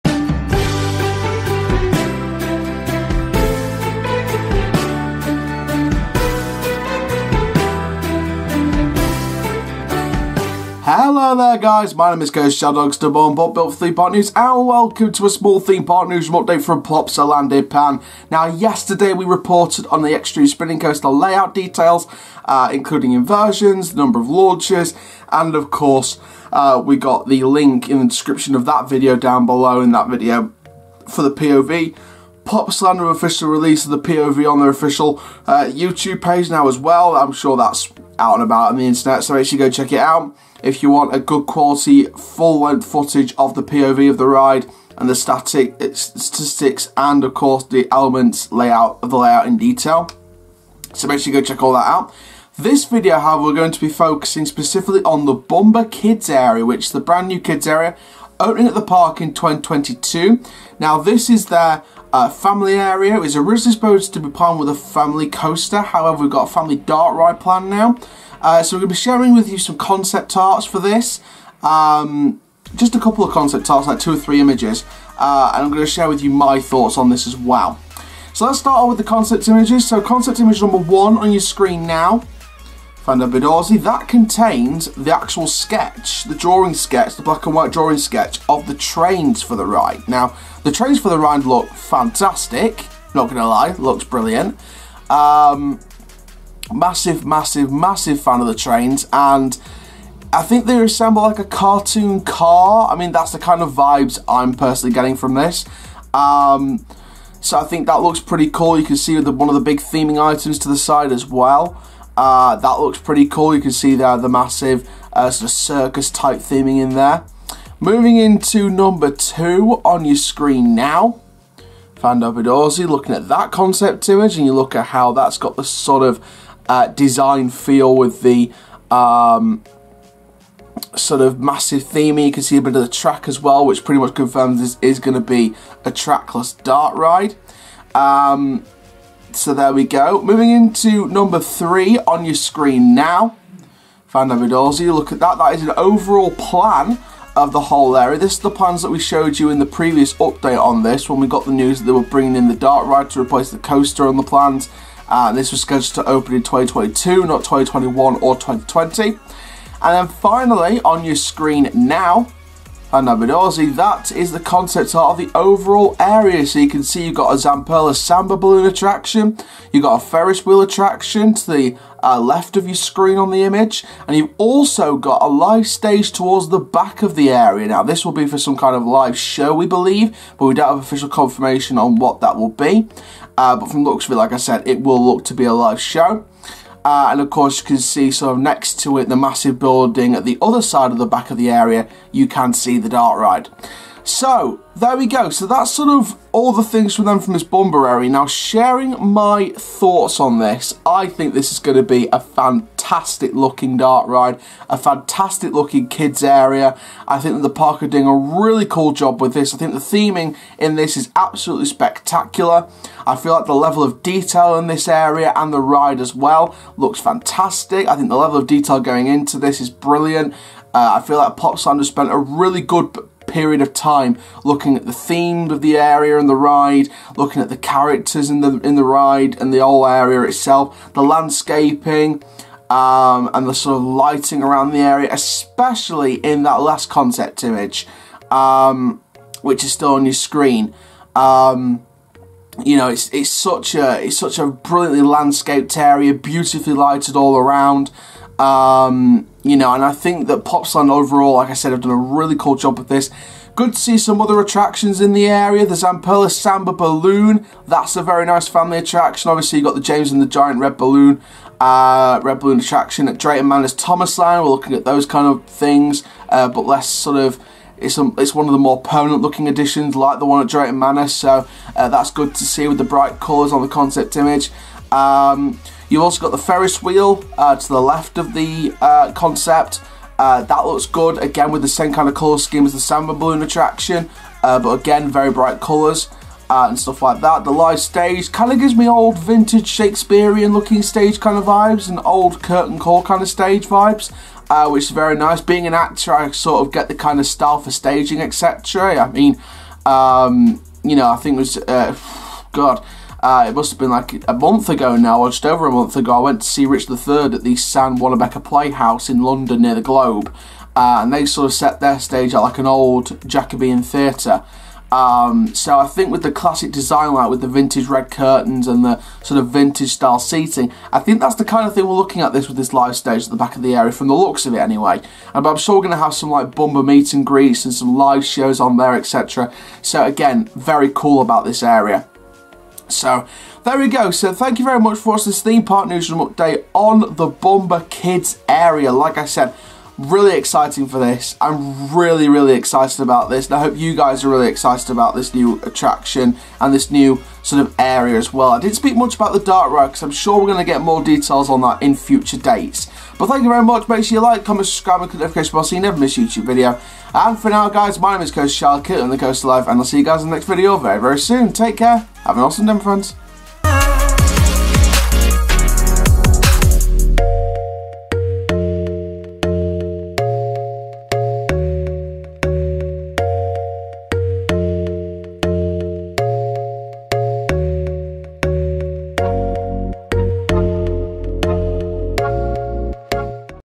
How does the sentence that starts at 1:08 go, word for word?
Uh, so we're going to be sharing with you some concept arts for this.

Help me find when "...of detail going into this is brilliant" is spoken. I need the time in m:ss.
3:38.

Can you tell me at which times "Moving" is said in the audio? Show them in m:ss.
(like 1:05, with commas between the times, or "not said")
1:57, 2:20.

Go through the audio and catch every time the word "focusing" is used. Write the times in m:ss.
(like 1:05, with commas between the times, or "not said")
0:53.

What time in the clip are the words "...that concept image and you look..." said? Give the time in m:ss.
2:03.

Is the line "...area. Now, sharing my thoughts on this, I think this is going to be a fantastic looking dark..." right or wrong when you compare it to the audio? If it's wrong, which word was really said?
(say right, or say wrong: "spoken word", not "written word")
right.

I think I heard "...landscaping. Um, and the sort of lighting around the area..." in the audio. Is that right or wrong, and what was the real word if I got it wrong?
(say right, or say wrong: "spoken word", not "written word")
right.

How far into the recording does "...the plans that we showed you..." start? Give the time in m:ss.
2:28.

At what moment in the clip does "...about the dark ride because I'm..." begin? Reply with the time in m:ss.
5:49.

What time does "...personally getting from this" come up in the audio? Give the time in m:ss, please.
1:44.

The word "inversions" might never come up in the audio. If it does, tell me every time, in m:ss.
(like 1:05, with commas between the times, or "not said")
0:23.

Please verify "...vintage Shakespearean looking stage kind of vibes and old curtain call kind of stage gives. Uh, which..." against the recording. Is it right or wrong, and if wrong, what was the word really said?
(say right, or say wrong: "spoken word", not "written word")
wrong: "vibes", not "gives".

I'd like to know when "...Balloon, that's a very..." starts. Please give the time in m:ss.
4:16.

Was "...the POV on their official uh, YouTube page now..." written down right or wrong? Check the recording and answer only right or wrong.
right.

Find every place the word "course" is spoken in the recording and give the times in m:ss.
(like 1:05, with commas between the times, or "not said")
0:25, 0:47, 3:07.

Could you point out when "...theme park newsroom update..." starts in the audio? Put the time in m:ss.
5:35.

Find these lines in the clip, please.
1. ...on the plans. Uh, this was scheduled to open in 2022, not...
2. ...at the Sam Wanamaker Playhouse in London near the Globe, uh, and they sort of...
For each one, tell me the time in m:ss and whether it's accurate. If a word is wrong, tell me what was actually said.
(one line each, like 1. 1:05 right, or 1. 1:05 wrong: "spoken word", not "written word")
1. 2:34 right
2. 5:07 right.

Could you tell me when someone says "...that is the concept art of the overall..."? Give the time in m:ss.
2:43.